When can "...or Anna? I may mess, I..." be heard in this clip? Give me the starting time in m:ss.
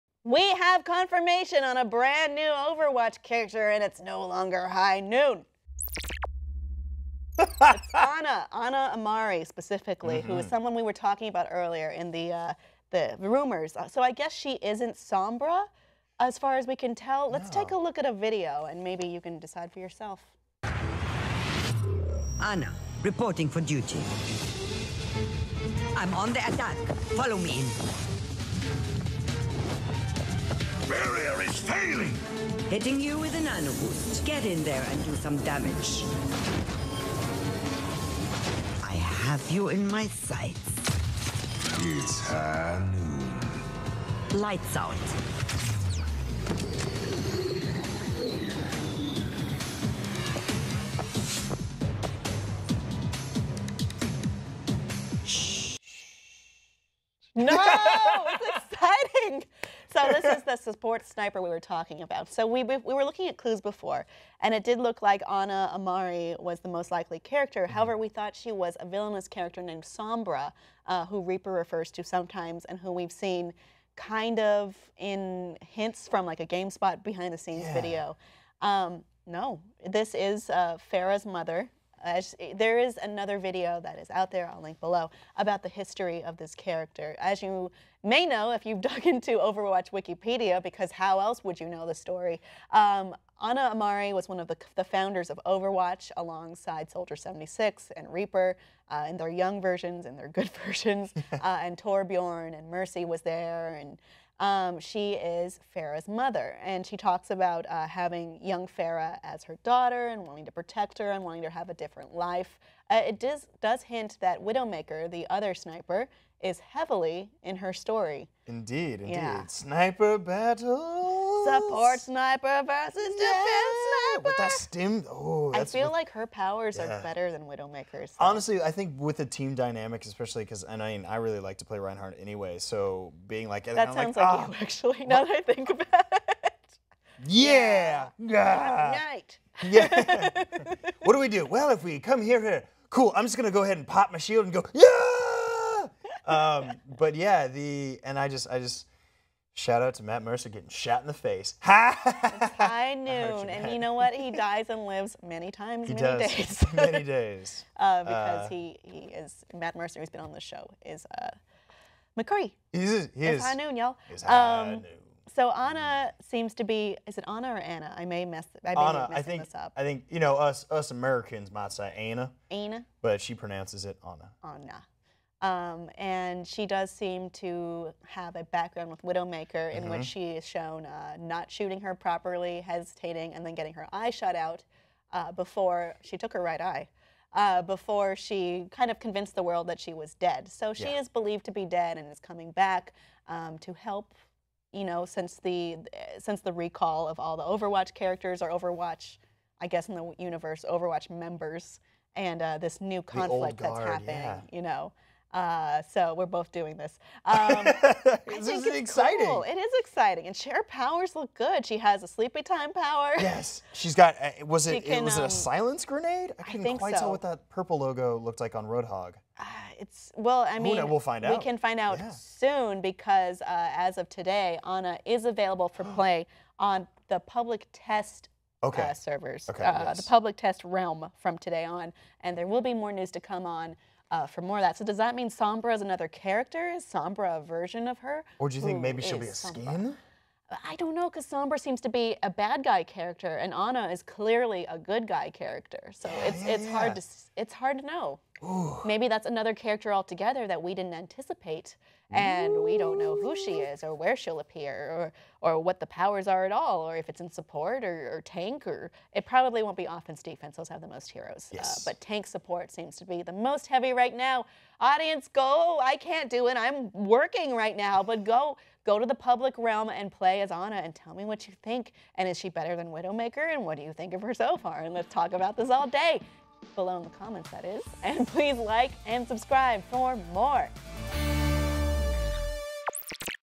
2:47.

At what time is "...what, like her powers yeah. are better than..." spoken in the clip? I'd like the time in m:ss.
2:05.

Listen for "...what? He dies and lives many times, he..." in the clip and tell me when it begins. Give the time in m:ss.
2:33.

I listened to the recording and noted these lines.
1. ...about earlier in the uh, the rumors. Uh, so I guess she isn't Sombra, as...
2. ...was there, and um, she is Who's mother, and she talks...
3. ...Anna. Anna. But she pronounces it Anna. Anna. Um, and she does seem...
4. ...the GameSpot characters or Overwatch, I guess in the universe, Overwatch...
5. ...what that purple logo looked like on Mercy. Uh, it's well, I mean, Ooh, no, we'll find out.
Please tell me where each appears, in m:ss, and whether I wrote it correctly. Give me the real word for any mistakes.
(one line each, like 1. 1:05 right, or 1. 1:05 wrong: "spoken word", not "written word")
1. 0:11 right
2. 1:43 wrong: "Pharah", not "Who"
3. 2:51 right
4. 3:17 wrong: "Overwatch", not "GameSpot"
5. 3:37 wrong: "Roadhog", not "Mercy".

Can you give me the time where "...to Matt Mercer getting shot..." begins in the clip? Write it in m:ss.
2:29.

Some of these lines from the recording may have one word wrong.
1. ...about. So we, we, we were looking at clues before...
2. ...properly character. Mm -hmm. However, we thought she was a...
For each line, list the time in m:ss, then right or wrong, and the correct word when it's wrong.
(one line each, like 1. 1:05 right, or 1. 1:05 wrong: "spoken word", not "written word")
1. 1:02 right
2. 1:06 wrong: "likely", not "properly".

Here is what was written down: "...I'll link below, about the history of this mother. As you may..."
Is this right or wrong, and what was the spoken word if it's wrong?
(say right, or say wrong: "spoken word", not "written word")
wrong: "character", not "mother".